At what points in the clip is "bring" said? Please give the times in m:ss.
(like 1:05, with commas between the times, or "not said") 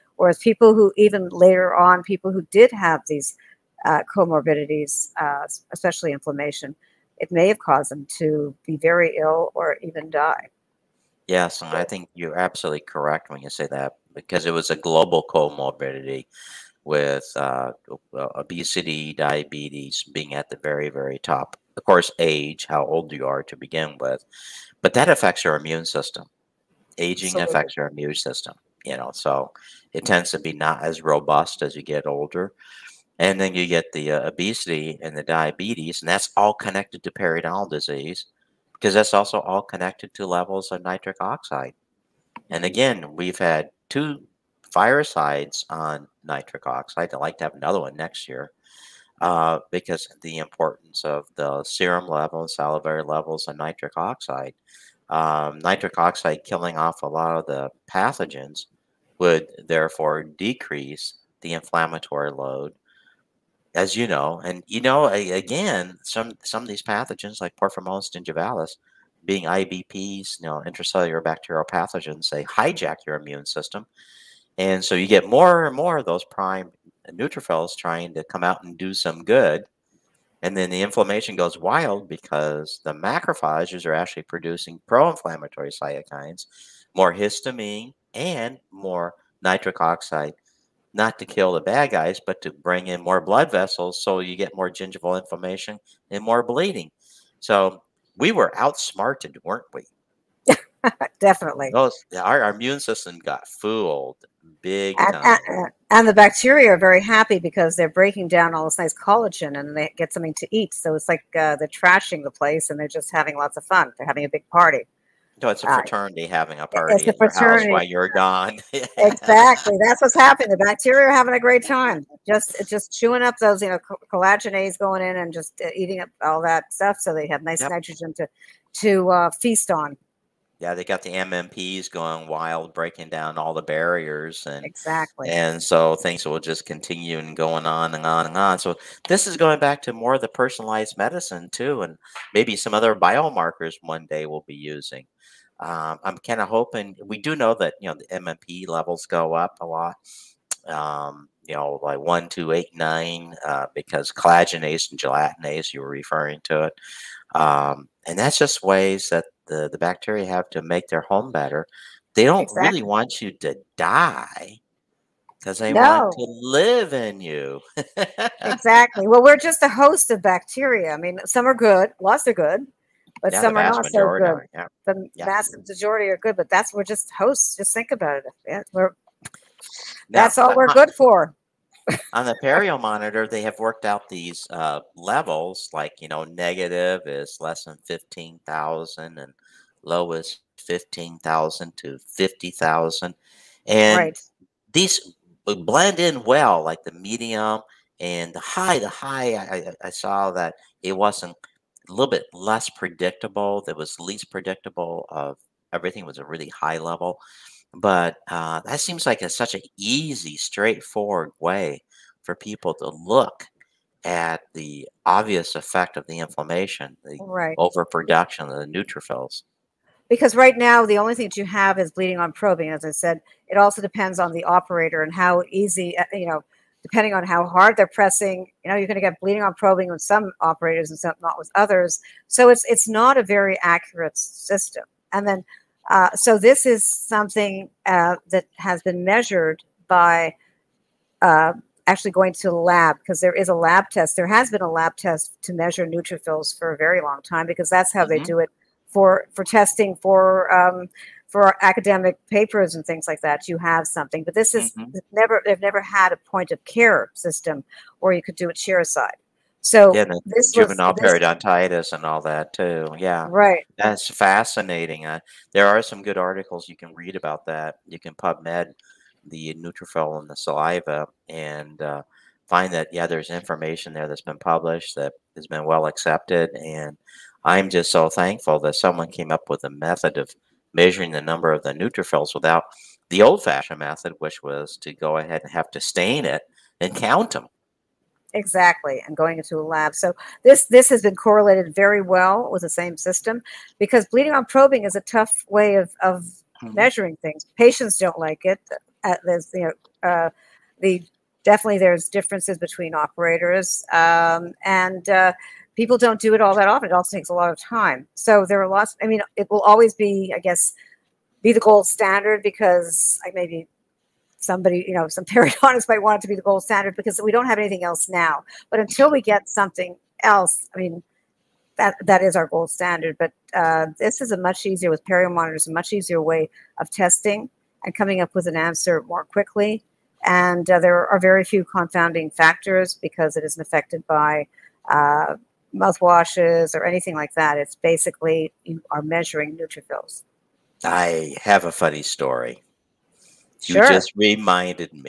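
1:32.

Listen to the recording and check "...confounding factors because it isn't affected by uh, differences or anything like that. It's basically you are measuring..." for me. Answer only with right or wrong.
wrong.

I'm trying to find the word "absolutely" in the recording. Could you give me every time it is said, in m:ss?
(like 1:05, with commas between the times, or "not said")
0:12, 0:27.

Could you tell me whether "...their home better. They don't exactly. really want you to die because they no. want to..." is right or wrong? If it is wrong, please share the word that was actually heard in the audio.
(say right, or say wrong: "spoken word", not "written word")
right.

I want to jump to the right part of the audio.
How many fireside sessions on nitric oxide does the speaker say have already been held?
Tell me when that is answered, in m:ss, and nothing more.
0:43.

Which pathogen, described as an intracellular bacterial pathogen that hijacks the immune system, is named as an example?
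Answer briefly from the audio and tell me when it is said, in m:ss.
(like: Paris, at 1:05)
Porphyromonas gingivalis, at 1:07.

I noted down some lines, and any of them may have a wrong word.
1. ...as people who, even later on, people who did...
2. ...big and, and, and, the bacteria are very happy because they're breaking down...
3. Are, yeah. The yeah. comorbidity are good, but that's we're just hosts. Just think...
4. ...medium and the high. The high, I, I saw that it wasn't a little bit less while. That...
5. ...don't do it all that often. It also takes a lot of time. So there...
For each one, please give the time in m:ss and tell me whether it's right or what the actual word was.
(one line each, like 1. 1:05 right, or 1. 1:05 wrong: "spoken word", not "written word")
1. 0:00 right
2. 1:44 right
3. 2:54 wrong: "majority", not "comorbidity"
4. 3:16 wrong: "predictable", not "while"
5. 5:05 right.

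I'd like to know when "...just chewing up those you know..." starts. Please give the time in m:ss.
2:02.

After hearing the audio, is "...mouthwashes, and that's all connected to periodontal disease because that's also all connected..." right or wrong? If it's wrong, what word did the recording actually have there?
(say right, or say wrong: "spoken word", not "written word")
wrong: "diabetes", not "mouthwashes".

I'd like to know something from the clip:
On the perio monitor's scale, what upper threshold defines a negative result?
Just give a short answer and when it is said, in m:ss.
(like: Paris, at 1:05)
15,000, at 3:07.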